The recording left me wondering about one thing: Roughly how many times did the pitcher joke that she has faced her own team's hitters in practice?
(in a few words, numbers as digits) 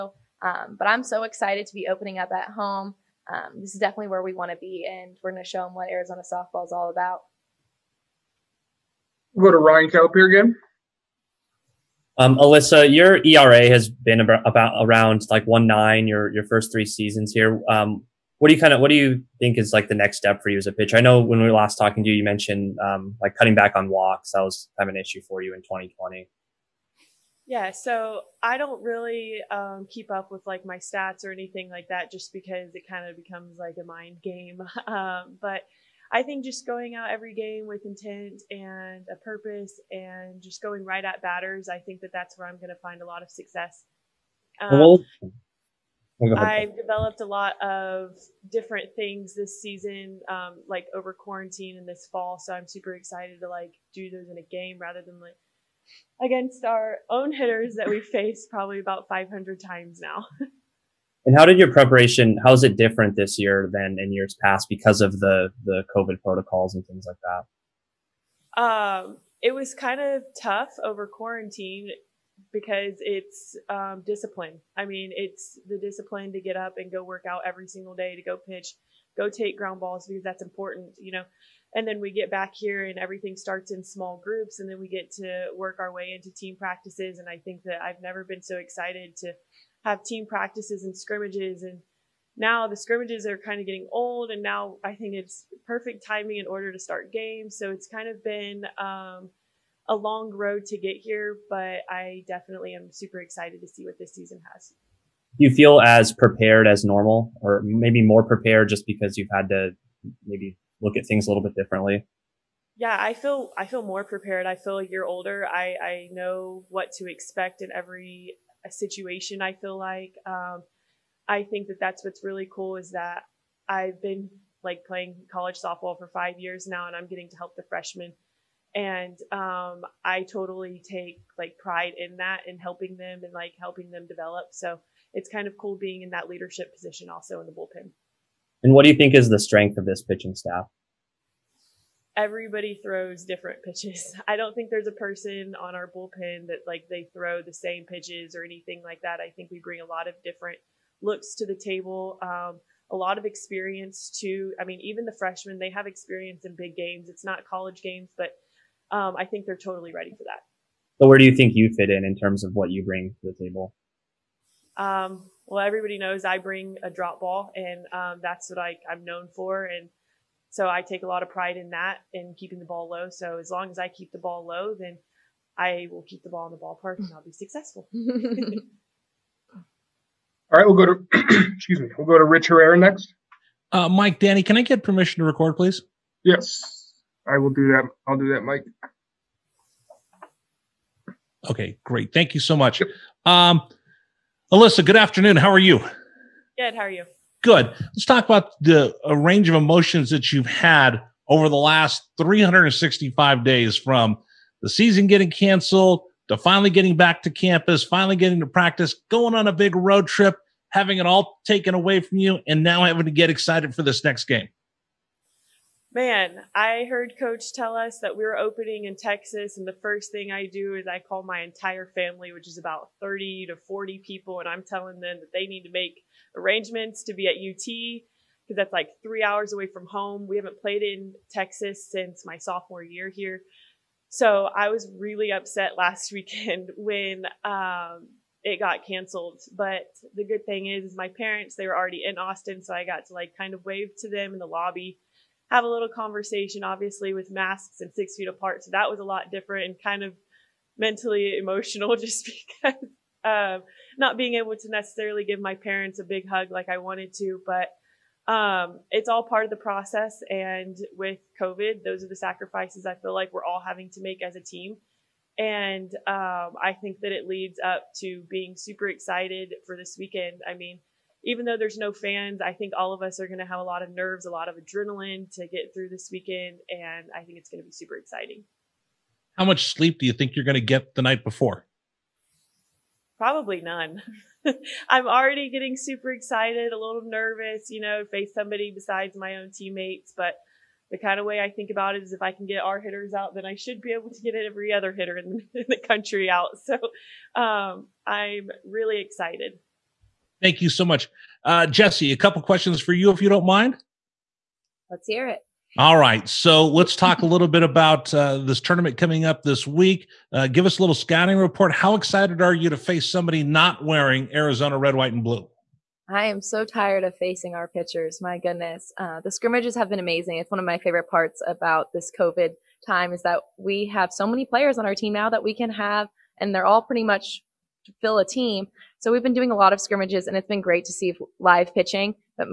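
500.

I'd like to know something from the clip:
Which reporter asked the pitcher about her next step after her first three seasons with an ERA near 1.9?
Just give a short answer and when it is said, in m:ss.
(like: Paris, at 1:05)
Ryan Kelapire, at 0:09.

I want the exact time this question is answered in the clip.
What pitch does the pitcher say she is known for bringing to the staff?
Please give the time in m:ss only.
2:46.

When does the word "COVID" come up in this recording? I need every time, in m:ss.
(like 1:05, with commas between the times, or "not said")
1:05, 4:21, 5:22.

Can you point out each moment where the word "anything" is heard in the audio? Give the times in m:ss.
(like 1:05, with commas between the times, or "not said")
0:31, 2:28.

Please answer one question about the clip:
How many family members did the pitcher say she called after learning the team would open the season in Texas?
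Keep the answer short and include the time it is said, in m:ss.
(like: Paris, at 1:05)
30 to 40, at 3:42.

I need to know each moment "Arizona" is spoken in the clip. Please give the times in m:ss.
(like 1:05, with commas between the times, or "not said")
0:05, 5:14.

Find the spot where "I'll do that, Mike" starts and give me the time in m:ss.
3:08.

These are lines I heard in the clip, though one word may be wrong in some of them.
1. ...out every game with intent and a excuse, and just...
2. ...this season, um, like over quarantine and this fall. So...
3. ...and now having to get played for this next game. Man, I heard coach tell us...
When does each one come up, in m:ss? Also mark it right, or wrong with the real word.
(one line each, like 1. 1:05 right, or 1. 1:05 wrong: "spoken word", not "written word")
1. 0:36 wrong: "purpose", not "excuse"
2. 0:49 right
3. 3:32 wrong: "excited", not "played".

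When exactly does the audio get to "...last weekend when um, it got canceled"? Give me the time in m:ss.
3:55.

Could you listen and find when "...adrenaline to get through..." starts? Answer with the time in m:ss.
4:34.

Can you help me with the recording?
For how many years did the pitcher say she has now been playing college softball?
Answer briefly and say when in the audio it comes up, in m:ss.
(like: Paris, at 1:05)
5, at 2:06.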